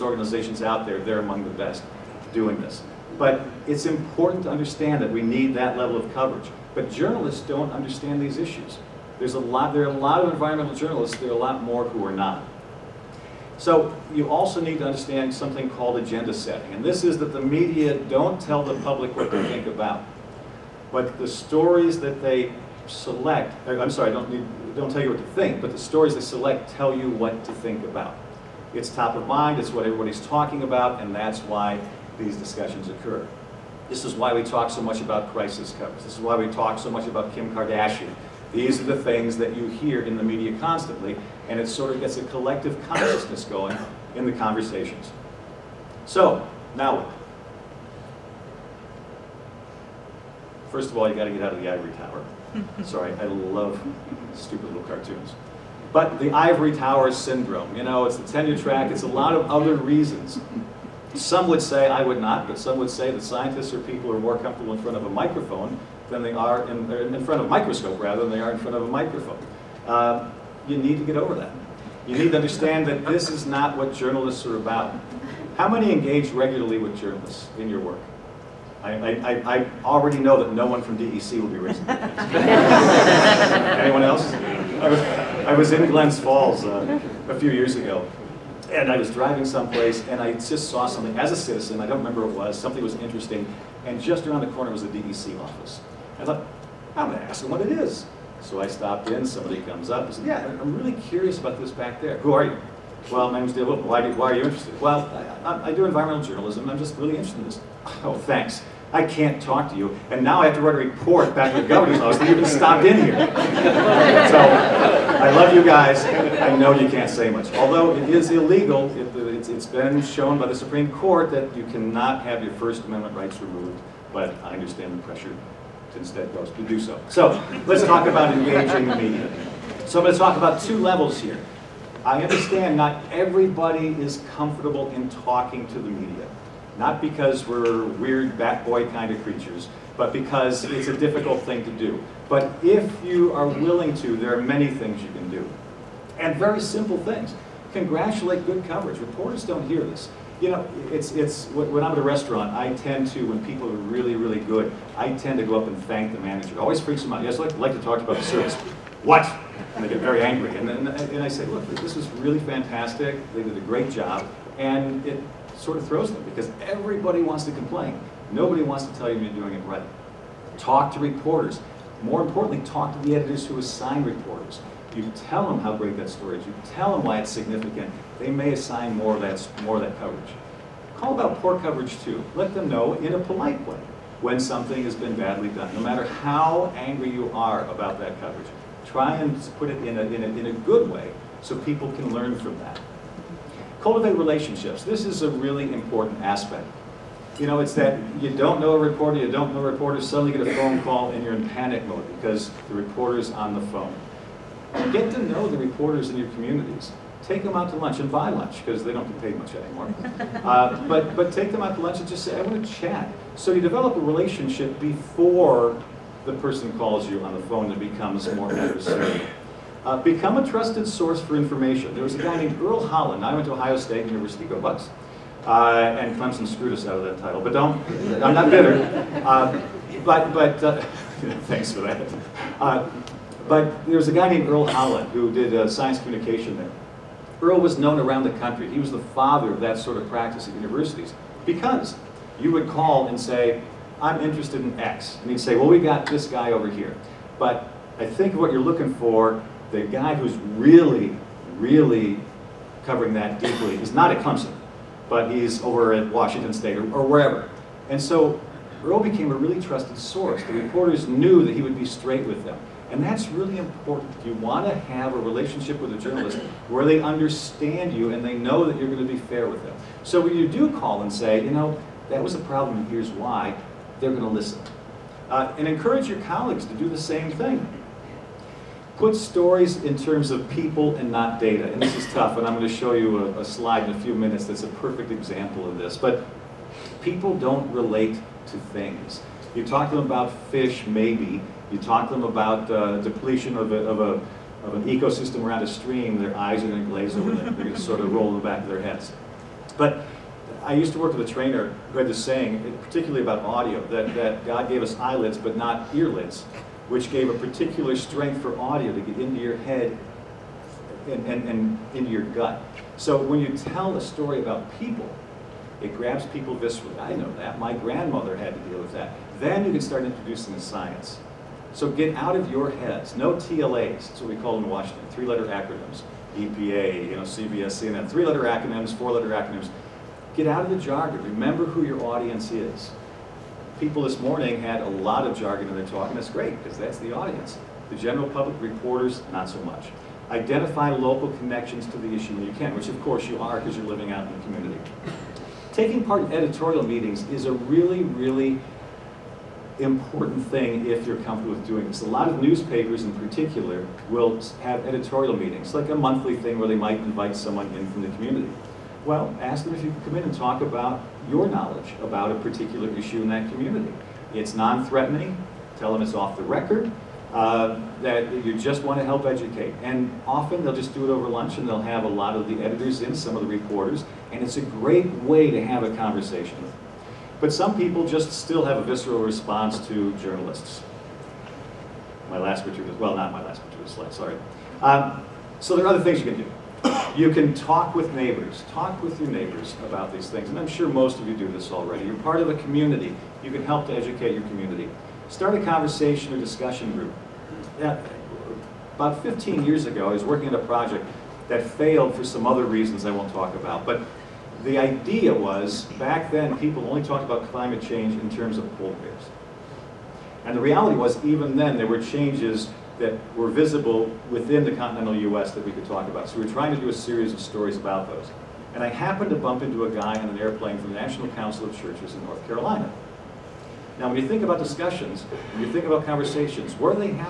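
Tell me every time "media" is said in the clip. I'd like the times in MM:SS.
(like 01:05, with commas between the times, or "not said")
00:17, 00:40, 02:08, 02:15.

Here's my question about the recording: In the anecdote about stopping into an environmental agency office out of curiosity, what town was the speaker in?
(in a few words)
Glens Falls.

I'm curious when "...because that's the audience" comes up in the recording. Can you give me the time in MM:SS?
05:36.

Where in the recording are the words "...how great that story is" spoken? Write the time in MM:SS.
02:55.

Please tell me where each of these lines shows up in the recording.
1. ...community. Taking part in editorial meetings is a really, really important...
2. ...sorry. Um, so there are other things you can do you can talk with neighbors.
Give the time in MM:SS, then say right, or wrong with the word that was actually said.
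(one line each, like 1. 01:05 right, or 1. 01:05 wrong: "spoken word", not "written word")
1. 05:44 right
2. 06:24 right.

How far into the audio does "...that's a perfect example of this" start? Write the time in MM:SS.
04:44.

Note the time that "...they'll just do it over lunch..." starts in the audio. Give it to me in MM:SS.
06:10.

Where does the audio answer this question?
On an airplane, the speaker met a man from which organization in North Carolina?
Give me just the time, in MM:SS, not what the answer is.
07:00.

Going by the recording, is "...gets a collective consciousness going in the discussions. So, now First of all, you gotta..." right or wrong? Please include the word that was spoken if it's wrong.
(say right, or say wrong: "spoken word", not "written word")
wrong: "conversations", not "discussions".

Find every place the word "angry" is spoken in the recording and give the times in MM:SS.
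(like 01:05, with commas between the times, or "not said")
02:40, 03:06.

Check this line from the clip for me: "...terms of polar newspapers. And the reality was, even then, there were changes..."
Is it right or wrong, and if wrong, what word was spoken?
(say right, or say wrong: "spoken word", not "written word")
wrong: "bears", not "newspapers".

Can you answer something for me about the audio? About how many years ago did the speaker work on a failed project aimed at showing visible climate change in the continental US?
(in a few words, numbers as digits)
15.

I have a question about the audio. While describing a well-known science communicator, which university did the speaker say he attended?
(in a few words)
Ohio State University.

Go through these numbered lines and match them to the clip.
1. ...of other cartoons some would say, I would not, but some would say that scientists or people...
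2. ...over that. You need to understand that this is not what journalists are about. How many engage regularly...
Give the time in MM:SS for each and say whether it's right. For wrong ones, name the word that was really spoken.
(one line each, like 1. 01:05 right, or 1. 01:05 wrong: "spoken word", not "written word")
1. 00:59 wrong: "reasons", not "cartoons"
2. 01:11 right.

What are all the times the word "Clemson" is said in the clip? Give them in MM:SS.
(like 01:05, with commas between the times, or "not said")
03:46, 04:14.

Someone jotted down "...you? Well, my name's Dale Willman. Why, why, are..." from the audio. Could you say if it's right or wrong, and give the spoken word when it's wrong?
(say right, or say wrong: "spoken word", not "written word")
right.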